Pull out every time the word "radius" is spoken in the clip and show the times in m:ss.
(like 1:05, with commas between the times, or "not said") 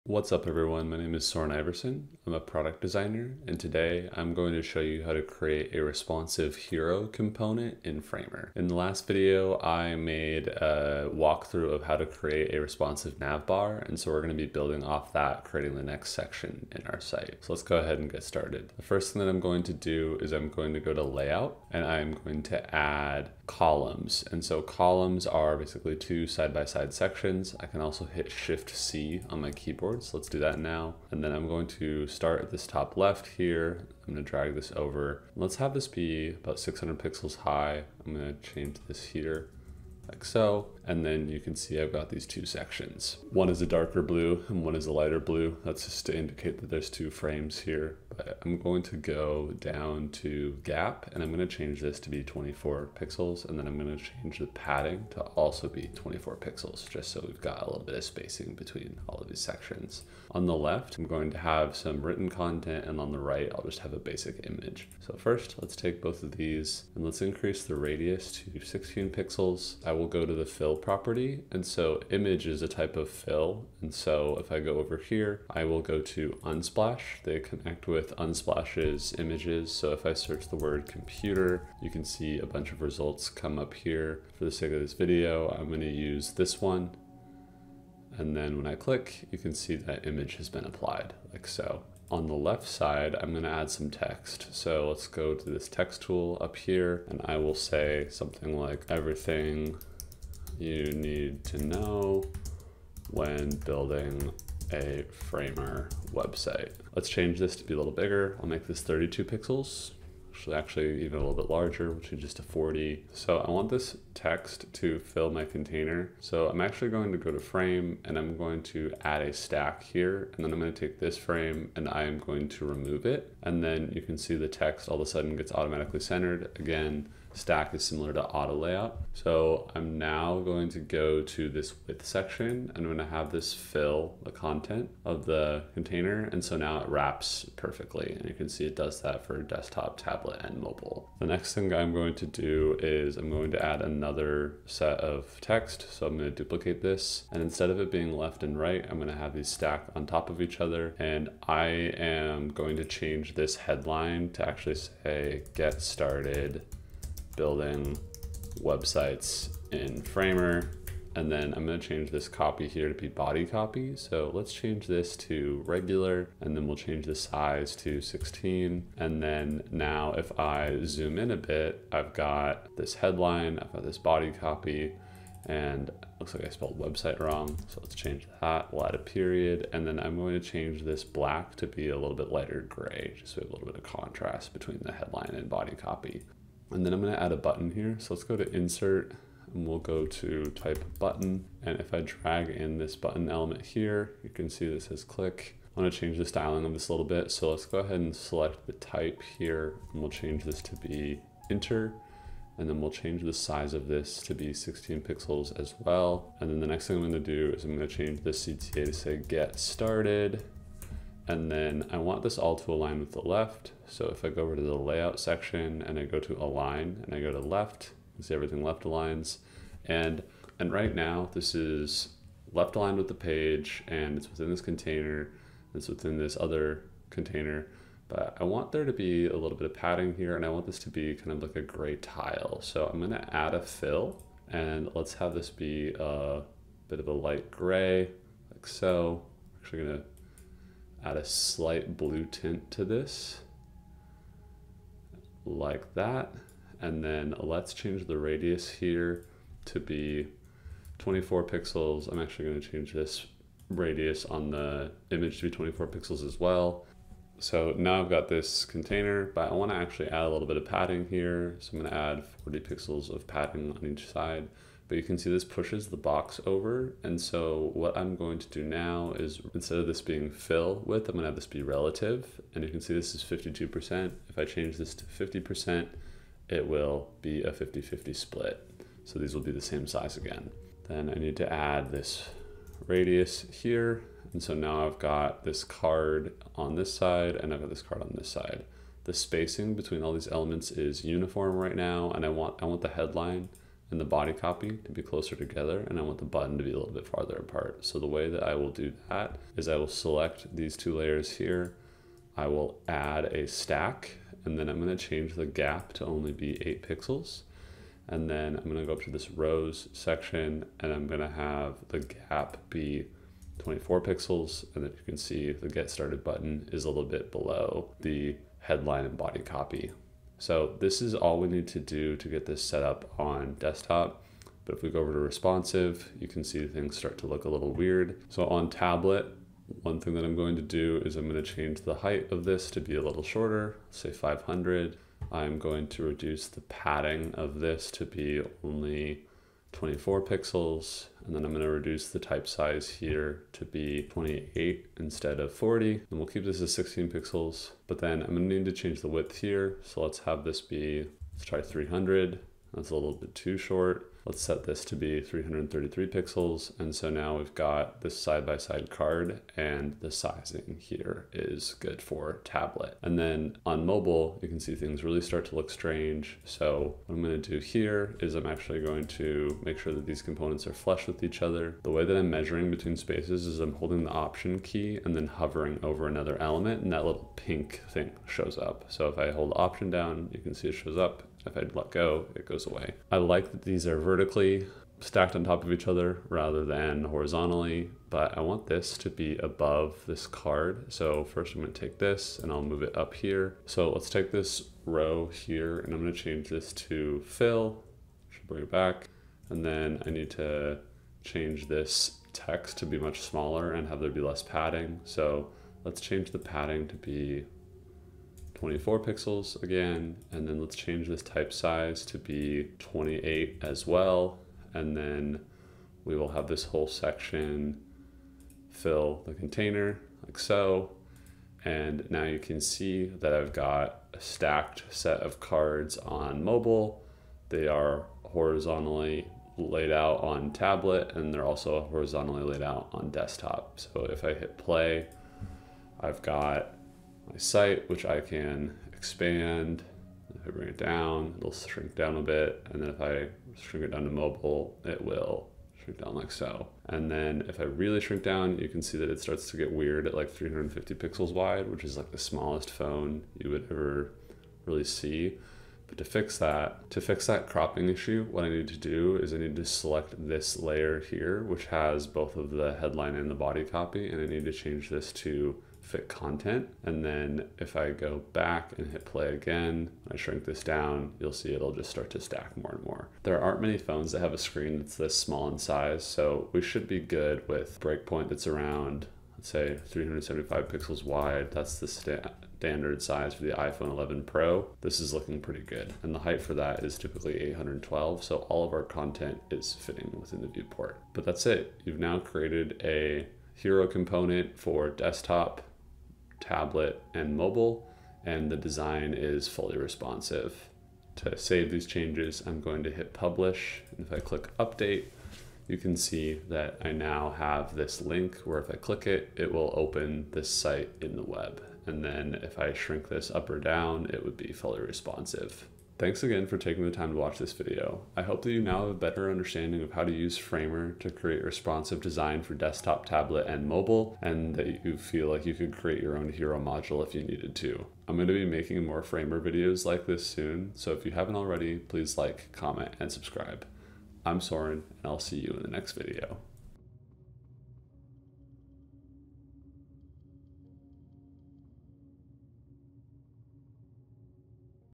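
1:07, 4:08, 4:13, 4:42.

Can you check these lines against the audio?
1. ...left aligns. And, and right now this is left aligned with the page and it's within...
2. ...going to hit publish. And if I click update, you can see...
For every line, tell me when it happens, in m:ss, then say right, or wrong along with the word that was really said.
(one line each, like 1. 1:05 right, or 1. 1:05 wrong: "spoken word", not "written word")
1. 3:38 right
2. 8:22 right.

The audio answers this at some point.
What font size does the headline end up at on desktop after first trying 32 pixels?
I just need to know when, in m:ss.
1:52.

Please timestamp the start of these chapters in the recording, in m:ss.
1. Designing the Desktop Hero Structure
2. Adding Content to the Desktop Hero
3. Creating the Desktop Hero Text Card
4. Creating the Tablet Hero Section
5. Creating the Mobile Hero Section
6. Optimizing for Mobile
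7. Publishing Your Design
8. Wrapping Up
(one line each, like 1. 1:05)
1. 0:18
2. 1:15
3. 3:34
4. 5:28
5. 6:04
6. 7:30
7. 8:13
8. 8:36.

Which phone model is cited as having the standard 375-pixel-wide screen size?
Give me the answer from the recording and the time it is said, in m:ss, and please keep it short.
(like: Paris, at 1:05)
iPhone 11 Pro, at 8:03.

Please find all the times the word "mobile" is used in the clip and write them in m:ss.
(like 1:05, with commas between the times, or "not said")
2:20, 6:03, 7:06, 7:24, 8:17, 8:43.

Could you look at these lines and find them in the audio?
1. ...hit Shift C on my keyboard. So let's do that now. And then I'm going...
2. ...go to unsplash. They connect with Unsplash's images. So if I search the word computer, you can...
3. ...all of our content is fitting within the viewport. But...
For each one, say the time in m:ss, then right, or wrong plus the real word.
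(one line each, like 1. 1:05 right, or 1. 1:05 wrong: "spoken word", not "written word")
1. 0:28 right
2. 1:15 right
3. 8:08 right.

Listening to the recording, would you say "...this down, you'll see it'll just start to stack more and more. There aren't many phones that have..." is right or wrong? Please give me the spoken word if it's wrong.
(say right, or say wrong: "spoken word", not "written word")
right.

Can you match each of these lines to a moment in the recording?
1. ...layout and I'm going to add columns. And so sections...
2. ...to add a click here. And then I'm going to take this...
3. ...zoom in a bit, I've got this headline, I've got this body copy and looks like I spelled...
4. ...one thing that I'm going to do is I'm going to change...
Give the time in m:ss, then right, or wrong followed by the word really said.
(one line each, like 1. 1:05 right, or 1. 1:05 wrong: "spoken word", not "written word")
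1. 0:21 wrong: "columns", not "sections"
2. 1:58 wrong: "stack", not "click"
3. 2:50 right
4. 5:29 right.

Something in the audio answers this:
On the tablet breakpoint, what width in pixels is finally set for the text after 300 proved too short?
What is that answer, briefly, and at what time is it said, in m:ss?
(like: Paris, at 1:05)
333 pixels, at 5:55.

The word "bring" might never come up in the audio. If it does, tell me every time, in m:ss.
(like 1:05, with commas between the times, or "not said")
6:38, 7:20.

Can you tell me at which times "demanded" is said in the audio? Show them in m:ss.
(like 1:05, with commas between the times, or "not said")
not said.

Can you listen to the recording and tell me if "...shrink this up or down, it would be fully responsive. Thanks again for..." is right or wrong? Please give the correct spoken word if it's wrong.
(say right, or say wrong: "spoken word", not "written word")
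right.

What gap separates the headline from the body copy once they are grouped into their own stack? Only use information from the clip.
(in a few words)
8 pixels.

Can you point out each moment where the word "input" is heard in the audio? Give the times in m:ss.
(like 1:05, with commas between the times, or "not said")
not said.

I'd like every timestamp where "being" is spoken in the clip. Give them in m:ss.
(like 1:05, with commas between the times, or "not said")
2:27, 4:30.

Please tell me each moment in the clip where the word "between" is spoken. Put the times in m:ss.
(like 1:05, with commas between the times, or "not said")
0:58, 3:04, 4:49, 6:12.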